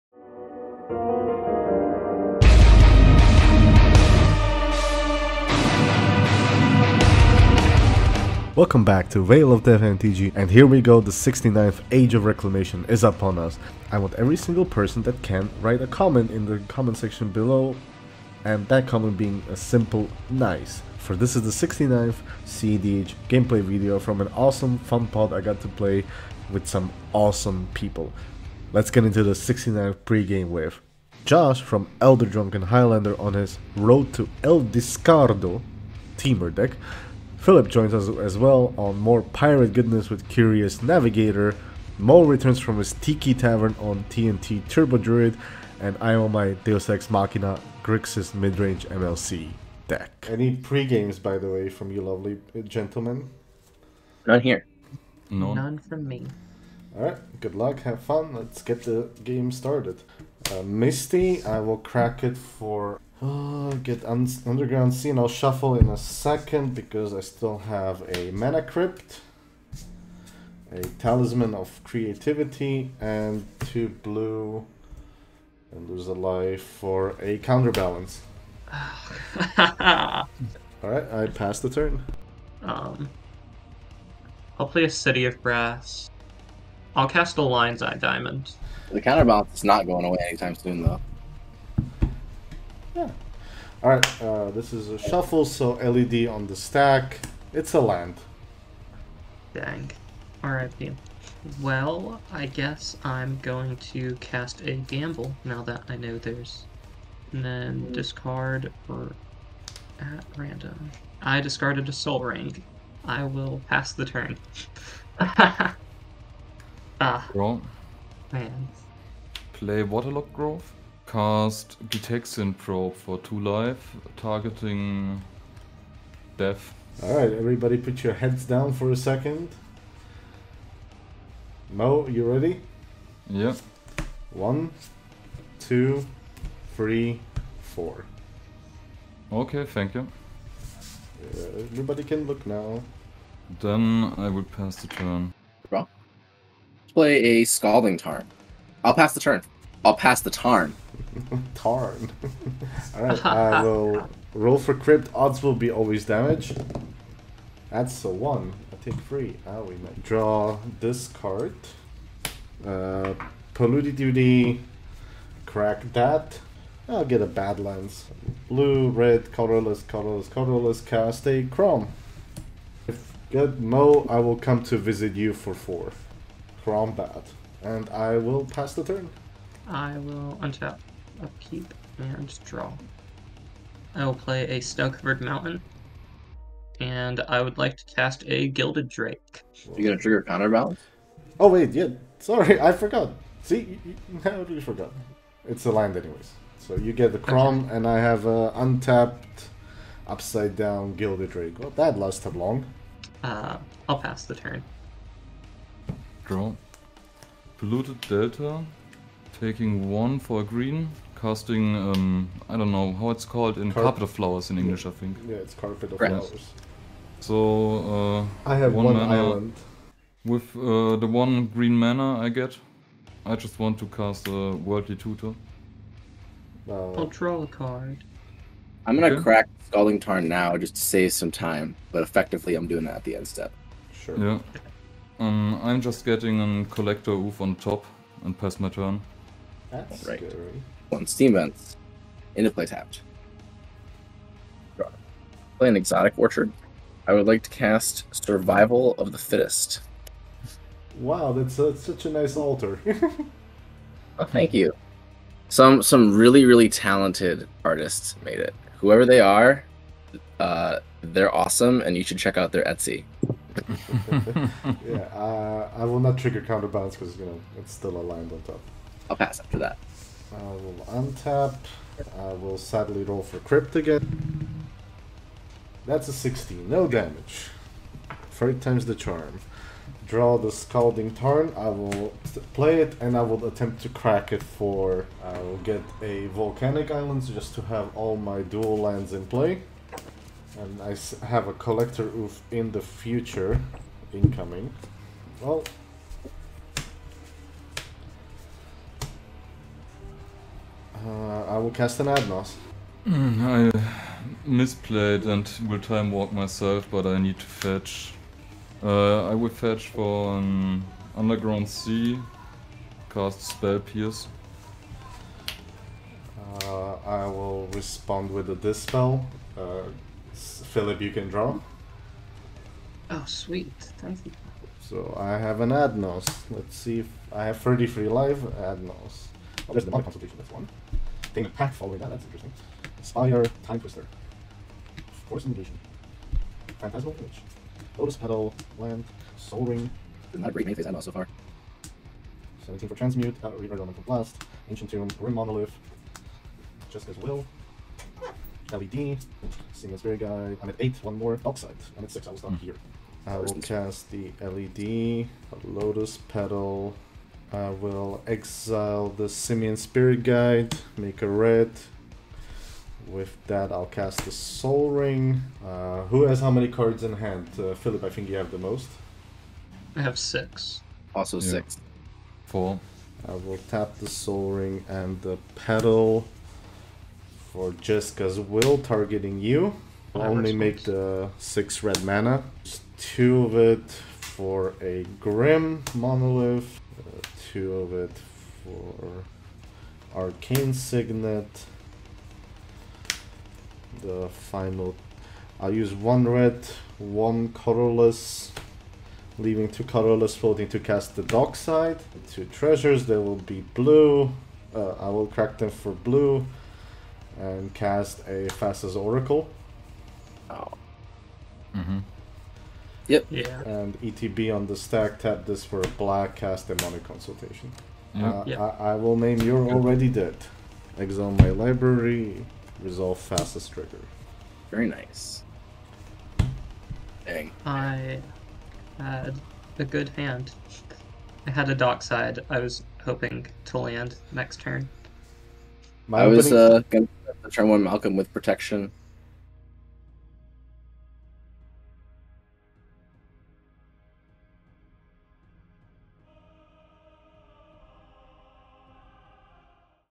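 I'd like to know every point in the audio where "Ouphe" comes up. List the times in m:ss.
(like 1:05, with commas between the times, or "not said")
3:57, 4:52.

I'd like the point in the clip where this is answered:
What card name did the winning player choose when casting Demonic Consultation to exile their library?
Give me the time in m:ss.
6:59.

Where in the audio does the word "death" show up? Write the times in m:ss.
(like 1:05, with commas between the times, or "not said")
0:09, 2:06.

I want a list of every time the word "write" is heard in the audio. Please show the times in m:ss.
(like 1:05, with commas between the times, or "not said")
0:15.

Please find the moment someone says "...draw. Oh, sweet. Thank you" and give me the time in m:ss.
5:21.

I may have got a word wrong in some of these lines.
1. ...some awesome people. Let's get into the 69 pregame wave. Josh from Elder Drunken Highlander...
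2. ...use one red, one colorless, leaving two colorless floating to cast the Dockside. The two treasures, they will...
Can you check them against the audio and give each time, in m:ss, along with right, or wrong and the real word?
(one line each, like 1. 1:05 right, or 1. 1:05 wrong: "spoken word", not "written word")
1. 0:26 right
2. 6:35 right.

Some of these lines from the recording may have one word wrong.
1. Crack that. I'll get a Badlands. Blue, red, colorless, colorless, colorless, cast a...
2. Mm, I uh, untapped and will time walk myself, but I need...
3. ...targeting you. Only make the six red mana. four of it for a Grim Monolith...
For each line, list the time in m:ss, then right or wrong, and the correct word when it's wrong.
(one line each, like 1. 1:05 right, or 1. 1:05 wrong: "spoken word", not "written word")
1. 2:45 right
2. 5:03 wrong: "misplayed", not "untapped"
3. 6:18 wrong: "two", not "four".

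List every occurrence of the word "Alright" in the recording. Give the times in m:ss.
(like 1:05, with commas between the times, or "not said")
0:56, 1:18, 2:07, 2:32.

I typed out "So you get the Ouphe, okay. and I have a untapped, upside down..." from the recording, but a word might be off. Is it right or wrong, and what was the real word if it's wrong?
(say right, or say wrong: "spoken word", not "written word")
wrong: "Crom", not "Ouphe".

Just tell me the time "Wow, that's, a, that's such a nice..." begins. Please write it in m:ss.
4:10.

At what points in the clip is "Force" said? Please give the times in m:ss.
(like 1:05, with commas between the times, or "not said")
5:35.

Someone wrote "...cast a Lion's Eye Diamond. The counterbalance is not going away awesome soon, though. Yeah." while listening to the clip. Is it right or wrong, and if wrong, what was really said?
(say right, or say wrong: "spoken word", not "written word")
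wrong: "anytime", not "awesome".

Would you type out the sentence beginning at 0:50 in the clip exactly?
Any pregames, by the way, from you lovely gentlemen?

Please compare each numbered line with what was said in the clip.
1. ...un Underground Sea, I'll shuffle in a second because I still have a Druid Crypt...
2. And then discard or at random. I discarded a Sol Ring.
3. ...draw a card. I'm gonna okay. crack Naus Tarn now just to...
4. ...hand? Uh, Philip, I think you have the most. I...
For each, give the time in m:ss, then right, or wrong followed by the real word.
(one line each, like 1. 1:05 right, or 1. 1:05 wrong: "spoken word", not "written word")
1. 1:04 wrong: "Mana", not "Druid"
2. 1:47 right
3. 3:47 wrong: "Scalding", not "Naus"
4. 6:07 right.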